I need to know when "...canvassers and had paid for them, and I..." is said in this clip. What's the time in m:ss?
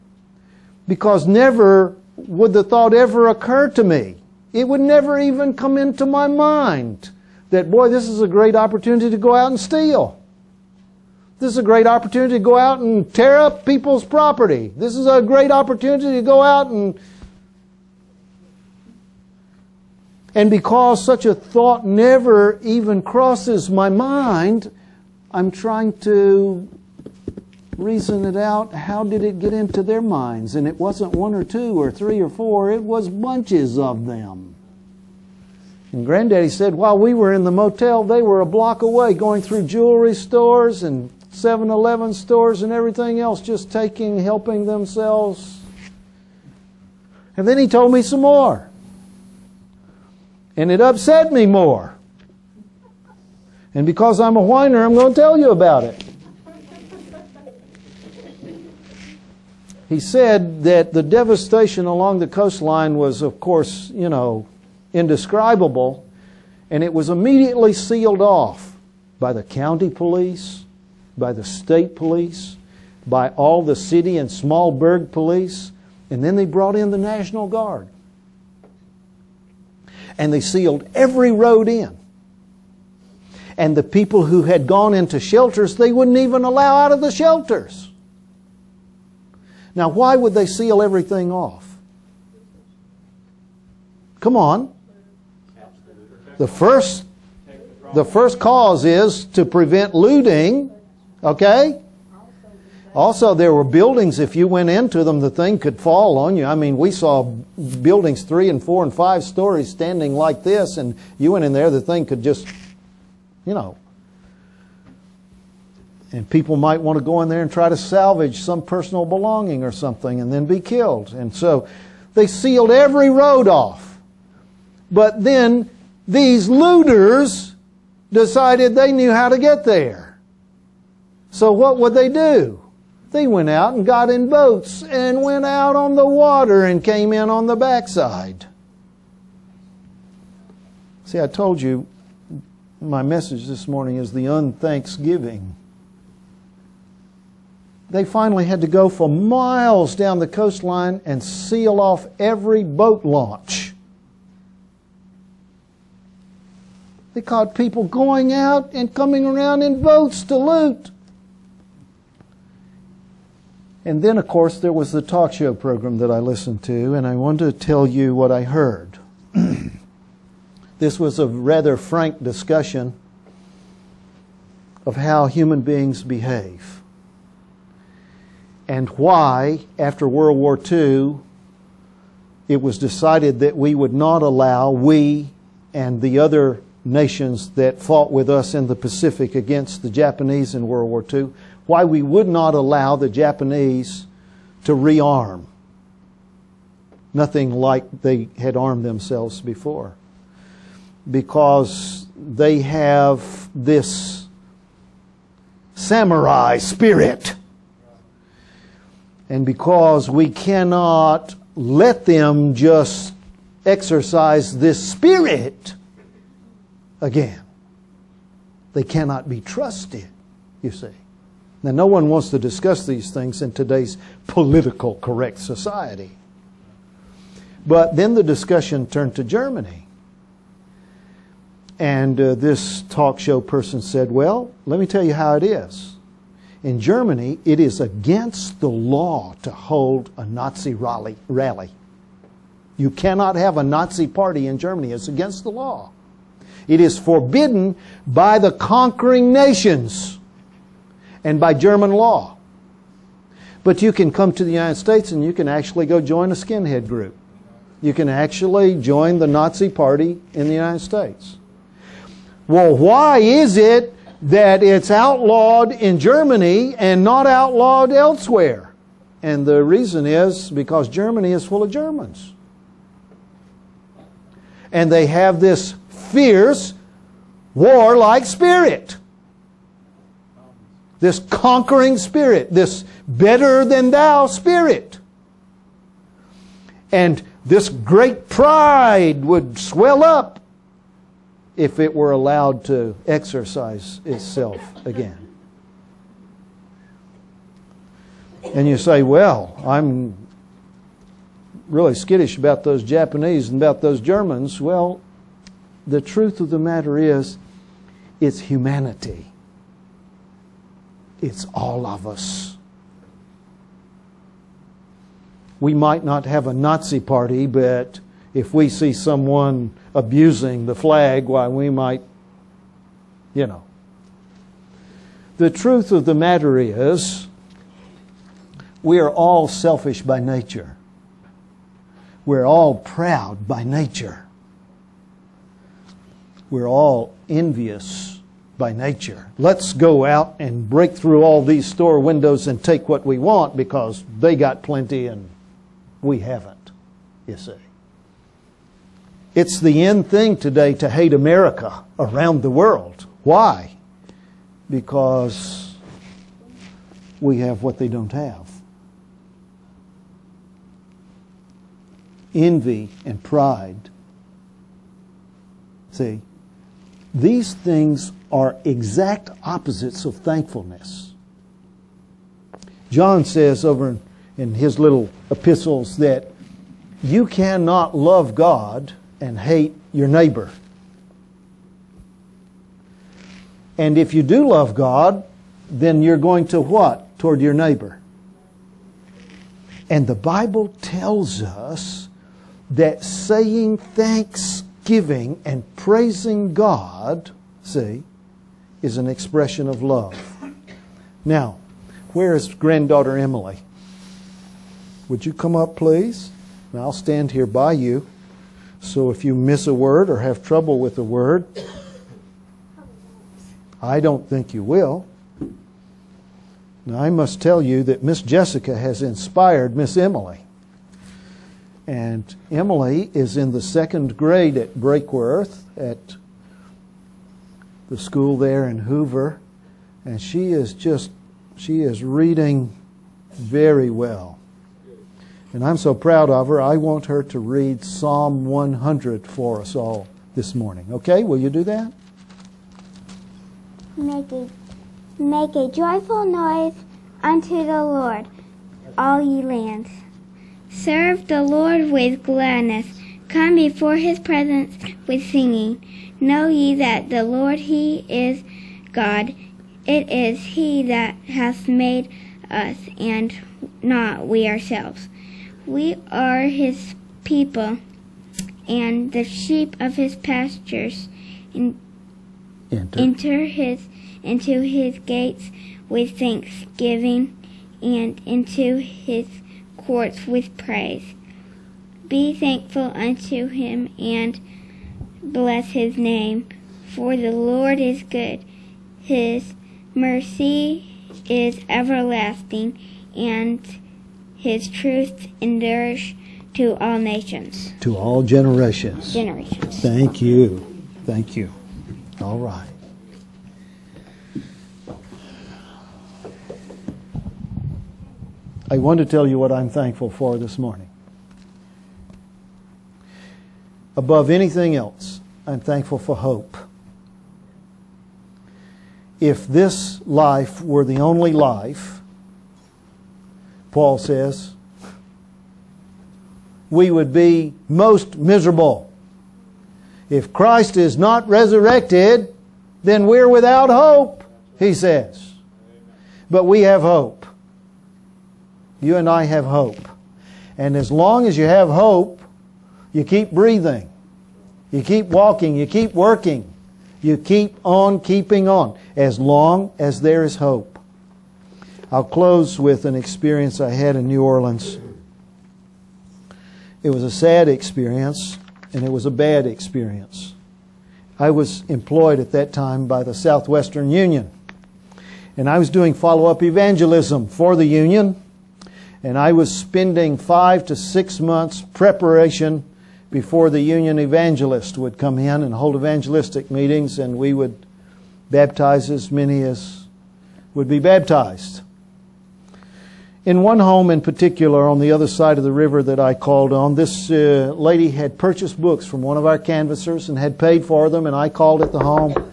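9:49.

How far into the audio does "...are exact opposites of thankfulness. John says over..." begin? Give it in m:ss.
6:08.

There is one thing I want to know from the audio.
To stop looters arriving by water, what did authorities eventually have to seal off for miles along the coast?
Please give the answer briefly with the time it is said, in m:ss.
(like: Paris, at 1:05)
boat launch, at 2:32.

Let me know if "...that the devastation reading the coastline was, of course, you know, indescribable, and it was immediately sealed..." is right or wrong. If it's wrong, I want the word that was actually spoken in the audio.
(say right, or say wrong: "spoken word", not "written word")
wrong: "along", not "reading".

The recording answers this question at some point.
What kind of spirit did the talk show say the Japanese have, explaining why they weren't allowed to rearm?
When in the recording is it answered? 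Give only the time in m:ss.
3:25.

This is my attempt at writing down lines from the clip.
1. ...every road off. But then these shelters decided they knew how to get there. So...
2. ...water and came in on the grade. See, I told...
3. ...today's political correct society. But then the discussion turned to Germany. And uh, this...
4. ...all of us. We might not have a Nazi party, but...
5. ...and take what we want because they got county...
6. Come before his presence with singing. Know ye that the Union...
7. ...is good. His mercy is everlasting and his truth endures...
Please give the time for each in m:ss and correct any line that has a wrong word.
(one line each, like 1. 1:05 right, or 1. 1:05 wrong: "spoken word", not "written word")
1. 2:02 wrong: "looters", not "shelters"
2. 2:16 wrong: "backside", not "grade"
3. 3:43 right
4. 5:11 right
5. 5:42 wrong: "plenty", not "county"
6. 7:33 wrong: "Lord", not "Union"
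7. 8:07 right.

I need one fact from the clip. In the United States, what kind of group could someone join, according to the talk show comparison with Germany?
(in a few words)
skinhead group.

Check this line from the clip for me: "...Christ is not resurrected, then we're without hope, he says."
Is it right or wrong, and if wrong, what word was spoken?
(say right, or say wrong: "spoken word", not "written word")
right.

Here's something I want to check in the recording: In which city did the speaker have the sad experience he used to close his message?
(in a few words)
New Orleans.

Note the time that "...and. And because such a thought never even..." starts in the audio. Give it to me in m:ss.
0:16.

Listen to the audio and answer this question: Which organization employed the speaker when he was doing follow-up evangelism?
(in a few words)
Southwestern Union.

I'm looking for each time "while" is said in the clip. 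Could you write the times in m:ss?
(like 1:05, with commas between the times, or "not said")
0:36, 5:21.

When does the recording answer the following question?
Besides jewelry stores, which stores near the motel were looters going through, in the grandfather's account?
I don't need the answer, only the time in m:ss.
0:41.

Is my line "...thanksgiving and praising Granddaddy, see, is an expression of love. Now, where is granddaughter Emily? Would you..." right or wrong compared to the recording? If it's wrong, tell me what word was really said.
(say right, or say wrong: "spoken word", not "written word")
wrong: "God", not "Granddaddy".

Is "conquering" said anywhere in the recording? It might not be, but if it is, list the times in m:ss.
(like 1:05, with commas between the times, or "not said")
4:08, 4:41.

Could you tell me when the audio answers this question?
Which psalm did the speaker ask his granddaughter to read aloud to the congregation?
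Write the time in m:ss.
7:17.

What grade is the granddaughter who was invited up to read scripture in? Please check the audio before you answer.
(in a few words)
second grade.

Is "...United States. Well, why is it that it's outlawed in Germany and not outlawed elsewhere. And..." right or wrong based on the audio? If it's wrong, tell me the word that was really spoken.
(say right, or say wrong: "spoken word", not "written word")
right.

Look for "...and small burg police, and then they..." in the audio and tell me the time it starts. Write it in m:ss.
1:14.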